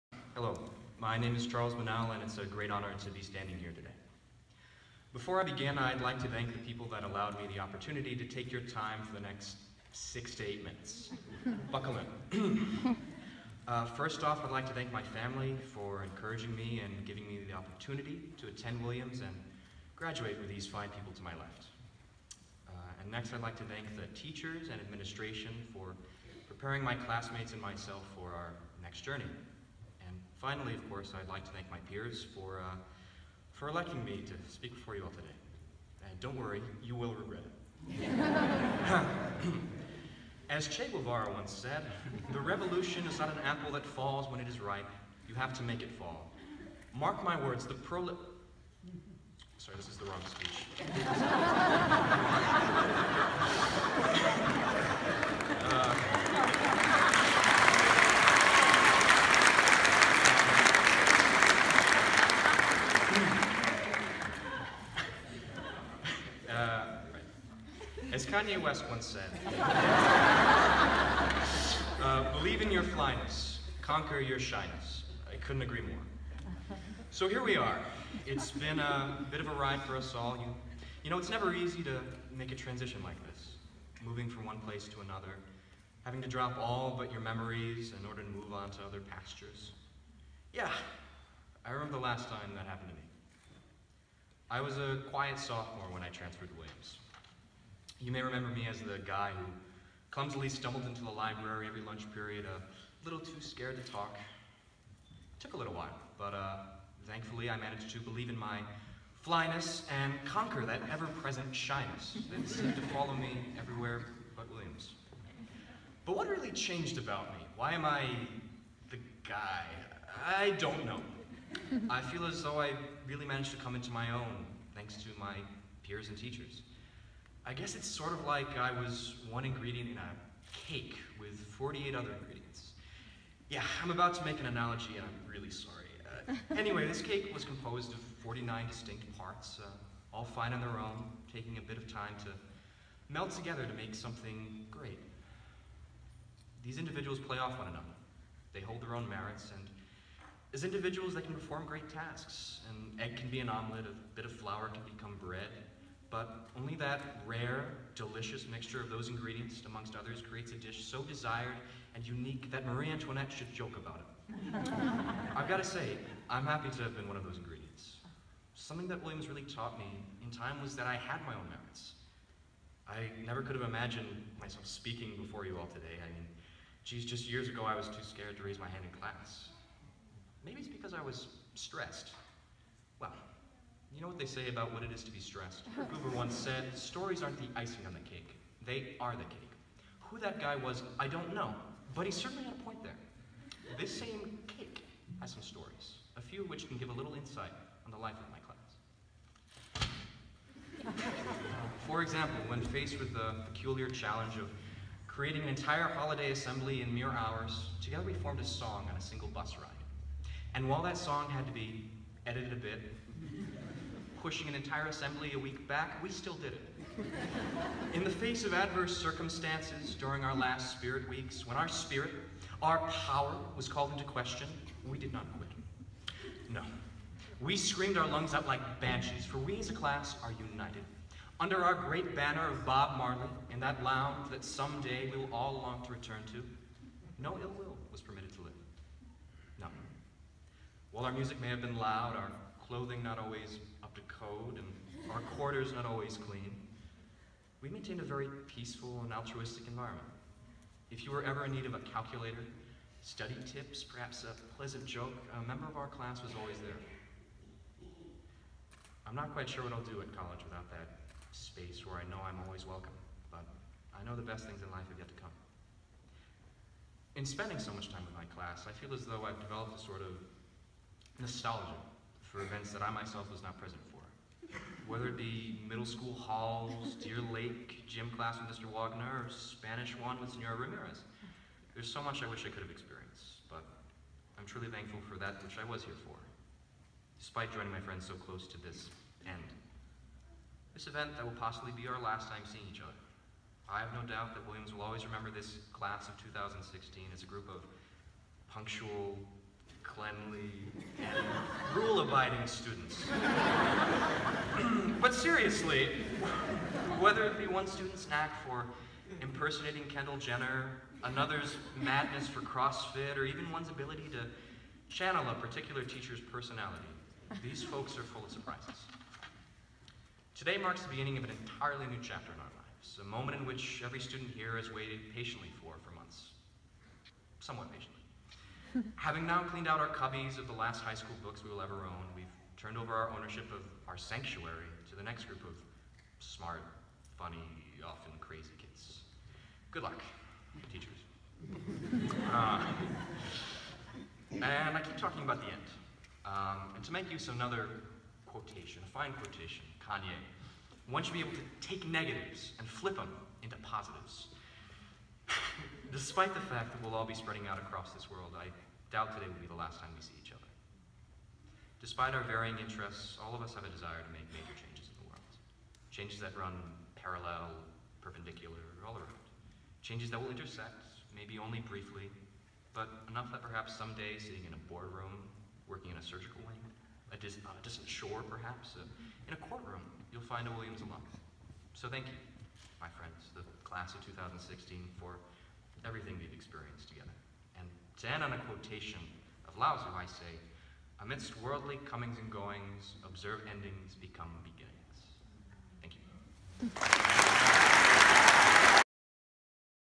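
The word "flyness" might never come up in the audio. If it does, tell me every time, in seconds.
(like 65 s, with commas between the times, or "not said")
72 s, 109 s.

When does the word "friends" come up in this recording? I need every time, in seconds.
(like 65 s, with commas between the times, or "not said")
287 s, 382 s.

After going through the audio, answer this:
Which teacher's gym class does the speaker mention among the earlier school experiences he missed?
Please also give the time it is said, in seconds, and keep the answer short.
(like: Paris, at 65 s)
Mr. Wagner, at 278 s.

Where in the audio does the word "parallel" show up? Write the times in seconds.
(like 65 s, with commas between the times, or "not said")
366 s.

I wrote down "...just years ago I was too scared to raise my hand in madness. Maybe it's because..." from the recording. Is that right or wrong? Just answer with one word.
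wrong.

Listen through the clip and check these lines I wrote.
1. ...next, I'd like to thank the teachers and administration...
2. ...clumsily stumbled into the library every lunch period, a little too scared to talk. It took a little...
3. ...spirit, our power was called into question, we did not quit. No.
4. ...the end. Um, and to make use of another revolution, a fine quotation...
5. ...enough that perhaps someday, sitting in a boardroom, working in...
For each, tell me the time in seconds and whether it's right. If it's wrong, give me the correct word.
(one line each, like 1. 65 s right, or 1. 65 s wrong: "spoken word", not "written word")
1. 23 s right
2. 100 s right
3. 221 s right
4. 345 s wrong: "quotation", not "revolution"
5. 373 s right.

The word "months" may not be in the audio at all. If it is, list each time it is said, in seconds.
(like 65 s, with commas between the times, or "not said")
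325 s.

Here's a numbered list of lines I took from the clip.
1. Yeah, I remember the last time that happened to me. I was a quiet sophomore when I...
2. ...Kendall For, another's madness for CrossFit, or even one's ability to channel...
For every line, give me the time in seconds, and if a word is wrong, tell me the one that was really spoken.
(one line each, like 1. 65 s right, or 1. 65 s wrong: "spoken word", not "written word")
1. 90 s right
2. 309 s wrong: "Jenner", not "For".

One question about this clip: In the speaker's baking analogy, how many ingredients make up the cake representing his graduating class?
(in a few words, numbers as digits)
49.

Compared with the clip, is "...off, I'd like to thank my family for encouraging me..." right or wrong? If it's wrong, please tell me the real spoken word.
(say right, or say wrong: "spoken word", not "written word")
right.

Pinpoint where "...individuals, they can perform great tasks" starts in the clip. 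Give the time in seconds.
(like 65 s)
150 s.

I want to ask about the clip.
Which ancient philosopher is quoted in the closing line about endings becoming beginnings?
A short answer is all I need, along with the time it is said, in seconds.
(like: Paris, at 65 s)
Lao Tzu, at 389 s.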